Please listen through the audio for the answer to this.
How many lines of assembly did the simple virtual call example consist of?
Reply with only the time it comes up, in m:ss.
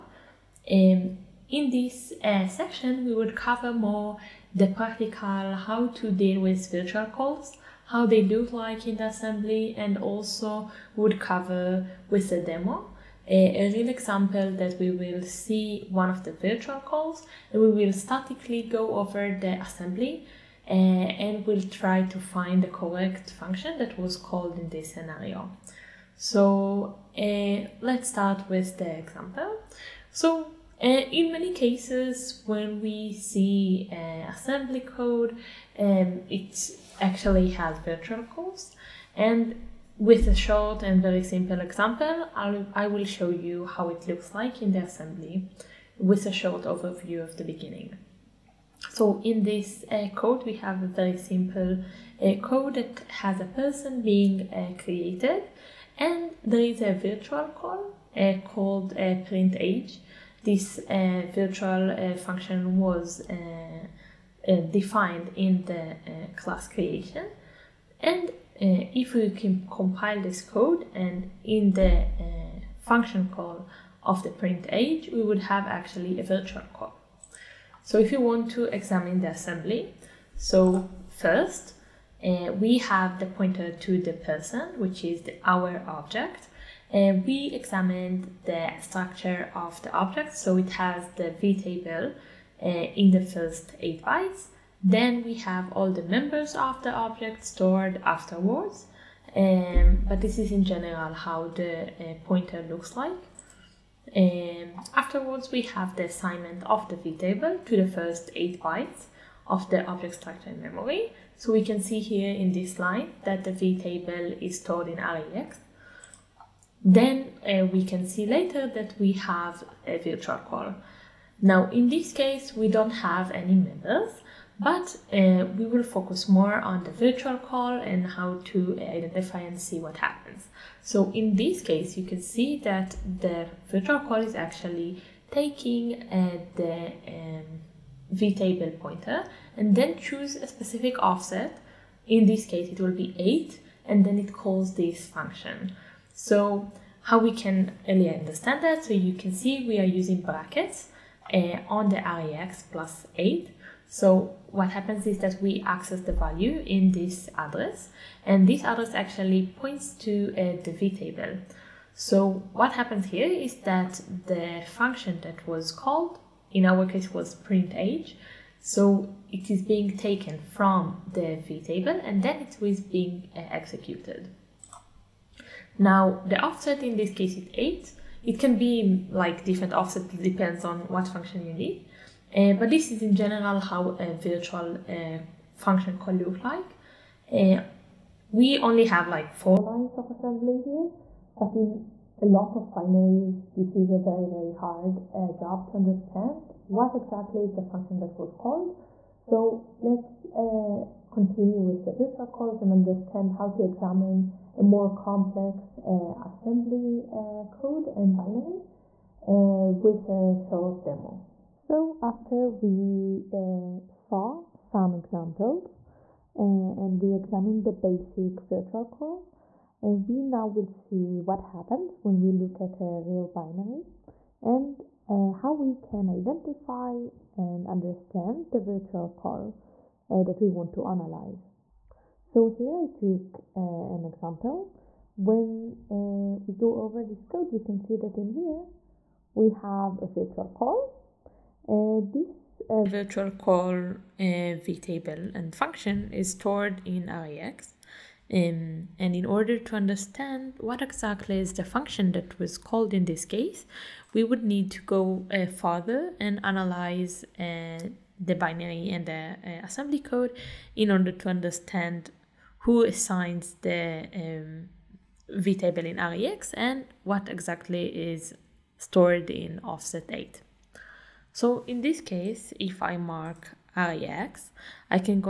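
3:09.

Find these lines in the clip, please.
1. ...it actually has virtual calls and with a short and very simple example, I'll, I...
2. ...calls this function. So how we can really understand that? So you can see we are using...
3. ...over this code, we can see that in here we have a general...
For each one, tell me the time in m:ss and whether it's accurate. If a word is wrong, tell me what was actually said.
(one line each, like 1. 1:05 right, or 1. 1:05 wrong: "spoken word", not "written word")
1. 0:36 right
2. 2:24 right
3. 3:56 wrong: "virtual", not "general".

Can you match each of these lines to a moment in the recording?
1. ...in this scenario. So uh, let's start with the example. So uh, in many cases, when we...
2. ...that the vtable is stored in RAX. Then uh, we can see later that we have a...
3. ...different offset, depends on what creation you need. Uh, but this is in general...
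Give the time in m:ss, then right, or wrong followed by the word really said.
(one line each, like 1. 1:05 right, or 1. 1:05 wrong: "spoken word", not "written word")
1. 0:24 right
2. 1:53 right
3. 2:59 wrong: "function", not "creation".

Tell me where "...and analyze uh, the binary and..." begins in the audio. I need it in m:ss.
4:16.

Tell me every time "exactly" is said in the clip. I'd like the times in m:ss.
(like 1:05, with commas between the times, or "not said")
3:16, 4:10, 4:27.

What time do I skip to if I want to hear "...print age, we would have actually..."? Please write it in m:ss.
1:14.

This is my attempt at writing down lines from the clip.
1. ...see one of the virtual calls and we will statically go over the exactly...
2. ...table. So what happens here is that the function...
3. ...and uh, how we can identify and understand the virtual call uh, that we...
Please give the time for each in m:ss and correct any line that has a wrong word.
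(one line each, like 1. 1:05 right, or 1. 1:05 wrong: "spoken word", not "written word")
1. 0:15 wrong: "assembly", not "exactly"
2. 2:40 right
3. 3:44 right.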